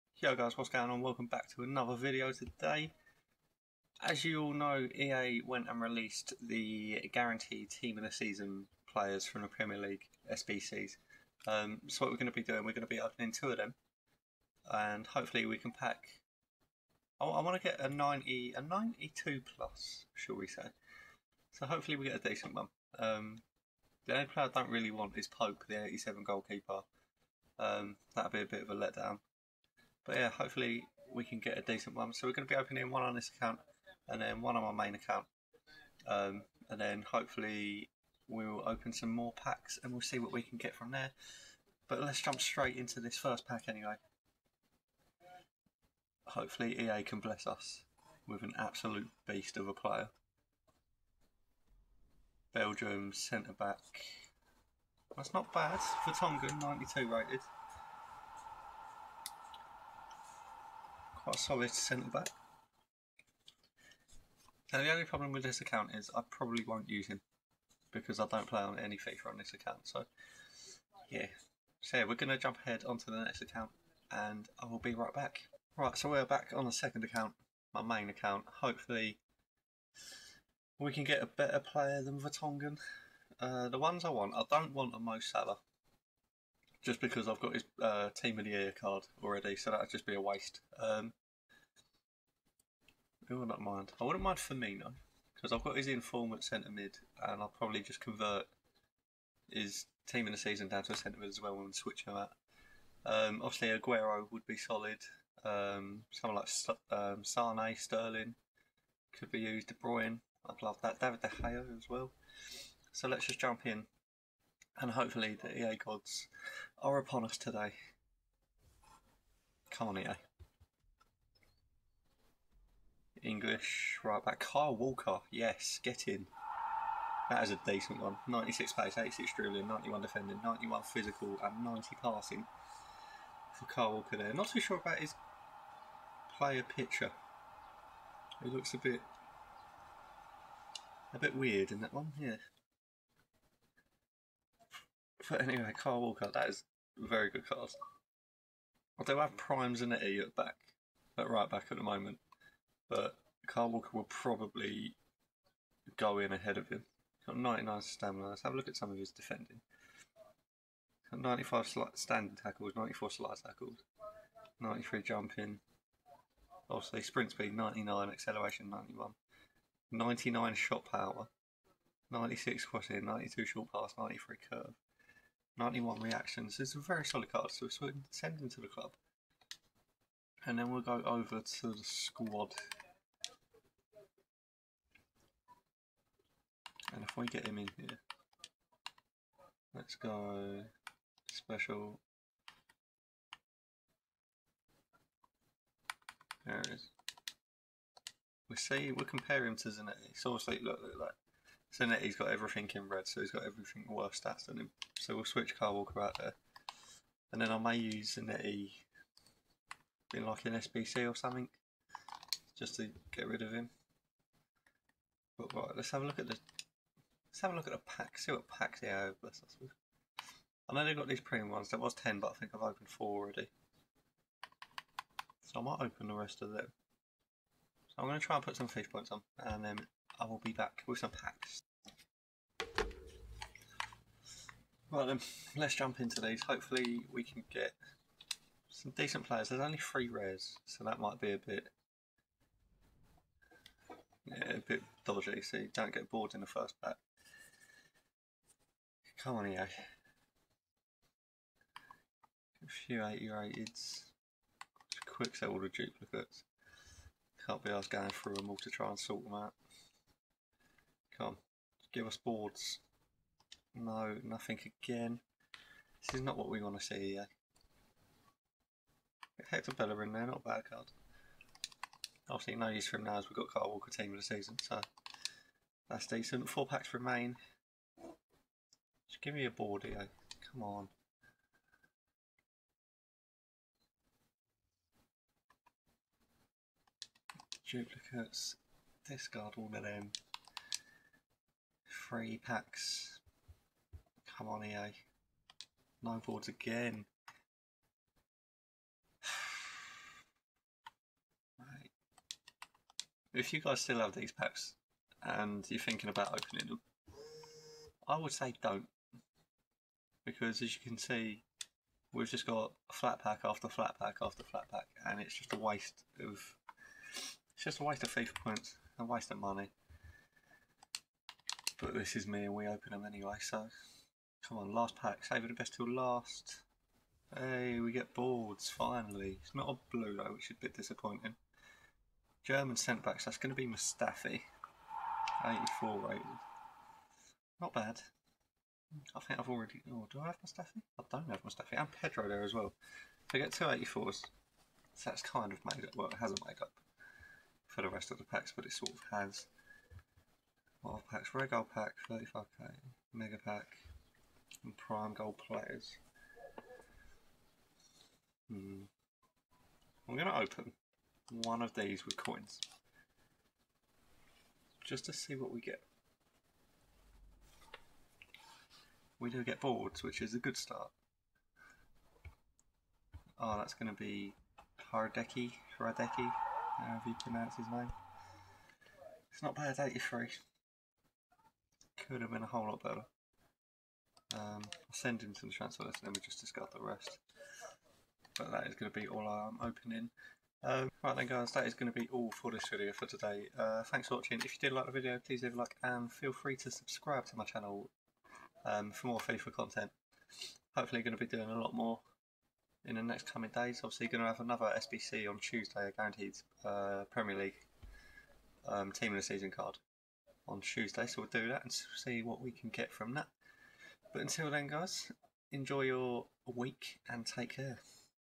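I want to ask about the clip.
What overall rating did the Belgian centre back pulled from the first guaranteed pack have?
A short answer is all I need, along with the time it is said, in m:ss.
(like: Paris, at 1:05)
92, at 0:56.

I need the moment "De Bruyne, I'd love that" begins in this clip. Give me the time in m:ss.
1:49.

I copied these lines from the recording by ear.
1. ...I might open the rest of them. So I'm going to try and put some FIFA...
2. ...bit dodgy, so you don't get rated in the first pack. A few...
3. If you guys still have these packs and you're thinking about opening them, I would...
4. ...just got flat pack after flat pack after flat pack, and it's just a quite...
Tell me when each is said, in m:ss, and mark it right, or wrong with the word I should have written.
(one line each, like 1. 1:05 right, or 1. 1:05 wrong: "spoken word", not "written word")
1. 3:45 right
2. 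4:04 wrong: "bored", not "rated"
3. 5:03 right
4. 5:12 wrong: "waste", not "quite".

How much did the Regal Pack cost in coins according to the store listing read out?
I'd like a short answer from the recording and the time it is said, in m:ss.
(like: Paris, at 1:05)
35k, at 5:52.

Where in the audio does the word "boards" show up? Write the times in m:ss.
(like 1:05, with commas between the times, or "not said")
4:22, 4:56, 5:28, 6:09.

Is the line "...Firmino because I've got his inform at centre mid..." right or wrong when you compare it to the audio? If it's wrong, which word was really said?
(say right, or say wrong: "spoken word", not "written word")
right.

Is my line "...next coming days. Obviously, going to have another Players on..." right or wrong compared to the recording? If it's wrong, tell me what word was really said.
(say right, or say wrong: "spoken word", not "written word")
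wrong: "SBC", not "Players".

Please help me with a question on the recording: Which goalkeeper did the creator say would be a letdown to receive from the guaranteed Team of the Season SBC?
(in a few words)
Pope.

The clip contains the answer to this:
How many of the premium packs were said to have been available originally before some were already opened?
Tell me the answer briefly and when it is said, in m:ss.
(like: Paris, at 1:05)
10, at 3:41.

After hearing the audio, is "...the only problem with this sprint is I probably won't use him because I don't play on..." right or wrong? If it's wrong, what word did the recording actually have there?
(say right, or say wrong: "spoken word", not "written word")
wrong: "account", not "sprint".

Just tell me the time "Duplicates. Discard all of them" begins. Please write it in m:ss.
4:47.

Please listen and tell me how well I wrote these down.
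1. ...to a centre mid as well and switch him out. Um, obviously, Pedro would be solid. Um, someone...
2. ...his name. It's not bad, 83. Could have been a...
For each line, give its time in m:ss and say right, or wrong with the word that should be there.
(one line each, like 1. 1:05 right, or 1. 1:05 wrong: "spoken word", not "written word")
1. 1:40 wrong: "Aguero", not "Pedro"
2. 6:17 right.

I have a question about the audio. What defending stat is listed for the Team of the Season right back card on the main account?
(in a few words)
91.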